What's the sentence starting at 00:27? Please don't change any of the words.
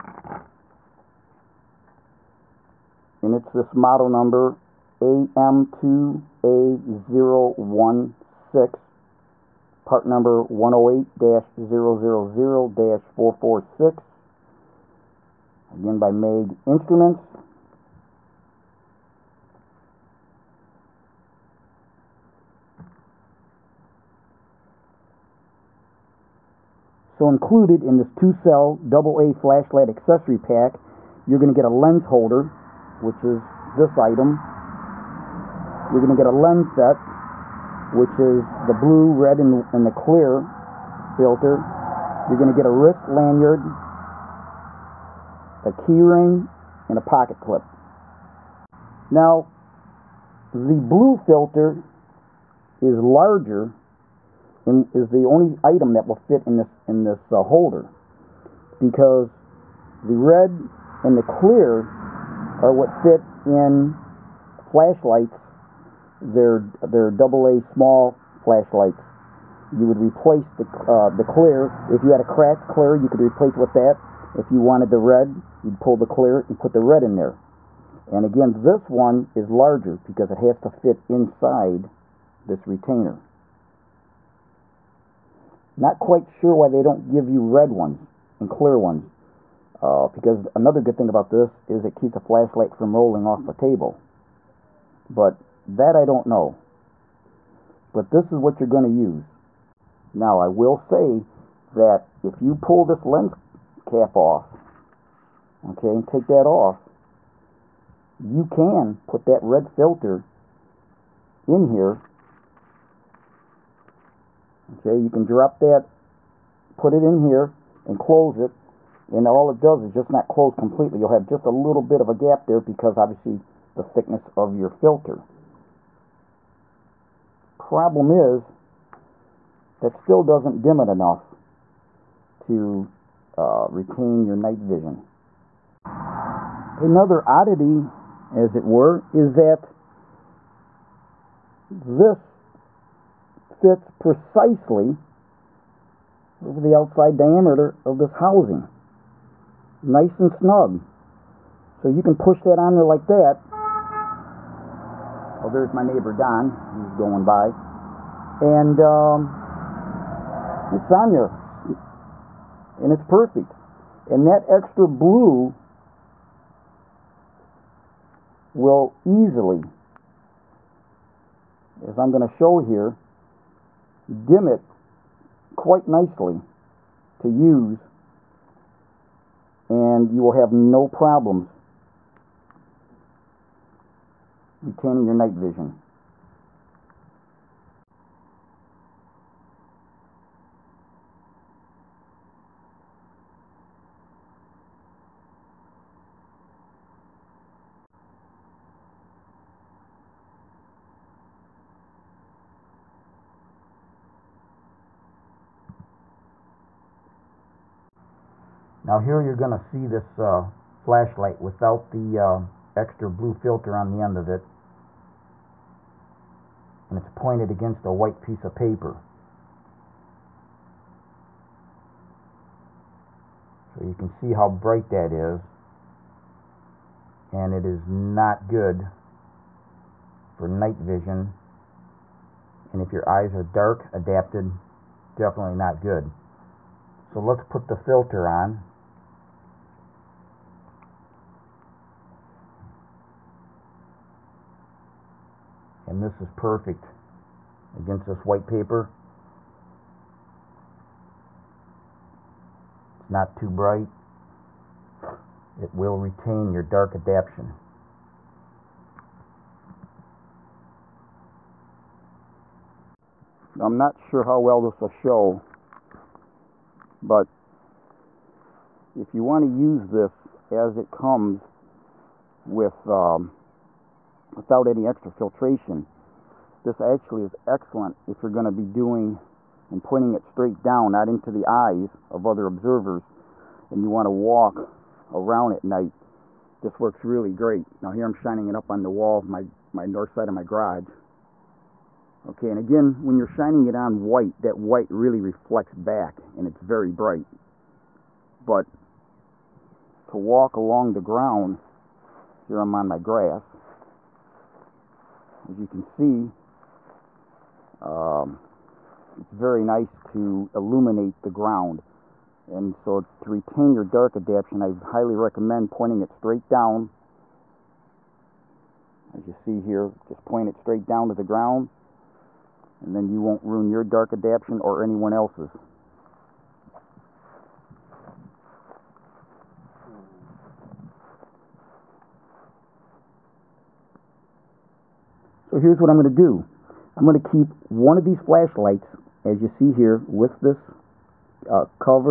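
So included in this two-cell AA flashlight accessory pack, you're going to get a lens holder, which is this item.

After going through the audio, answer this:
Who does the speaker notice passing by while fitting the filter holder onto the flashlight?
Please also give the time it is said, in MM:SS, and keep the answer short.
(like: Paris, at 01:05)
Don, at 02:35.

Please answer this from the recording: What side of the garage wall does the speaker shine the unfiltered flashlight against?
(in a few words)
North side.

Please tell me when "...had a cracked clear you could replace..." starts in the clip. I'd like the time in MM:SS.
01:12.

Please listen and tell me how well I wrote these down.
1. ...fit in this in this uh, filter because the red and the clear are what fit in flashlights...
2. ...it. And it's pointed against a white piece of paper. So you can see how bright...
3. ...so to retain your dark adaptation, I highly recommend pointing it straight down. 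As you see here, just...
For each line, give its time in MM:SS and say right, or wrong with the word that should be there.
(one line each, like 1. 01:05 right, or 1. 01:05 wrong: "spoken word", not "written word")
1. 00:56 wrong: "holder", not "filter"
2. 03:34 right
3. 05:12 right.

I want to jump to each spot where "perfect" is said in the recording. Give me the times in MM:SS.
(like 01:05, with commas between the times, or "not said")
02:43, 04:06.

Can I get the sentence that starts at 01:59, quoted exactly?
And all it does is just not close completely.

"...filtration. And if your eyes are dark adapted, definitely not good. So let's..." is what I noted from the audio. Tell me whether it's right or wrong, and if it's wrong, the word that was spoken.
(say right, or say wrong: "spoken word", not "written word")
wrong: "vision", not "filtration".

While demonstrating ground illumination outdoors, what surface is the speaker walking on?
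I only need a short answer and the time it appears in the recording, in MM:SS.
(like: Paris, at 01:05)
Grass, at 05:02.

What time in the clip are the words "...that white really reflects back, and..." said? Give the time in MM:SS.
04:54.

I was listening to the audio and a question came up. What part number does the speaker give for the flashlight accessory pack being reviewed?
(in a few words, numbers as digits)
108-000-446.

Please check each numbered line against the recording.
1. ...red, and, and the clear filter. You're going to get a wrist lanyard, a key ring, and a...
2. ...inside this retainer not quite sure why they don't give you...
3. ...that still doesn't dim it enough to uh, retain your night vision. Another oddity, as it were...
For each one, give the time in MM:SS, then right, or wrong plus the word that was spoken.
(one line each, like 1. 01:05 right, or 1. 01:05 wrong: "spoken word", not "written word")
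1. 00:39 right
2. 01:21 right
3. 02:09 right.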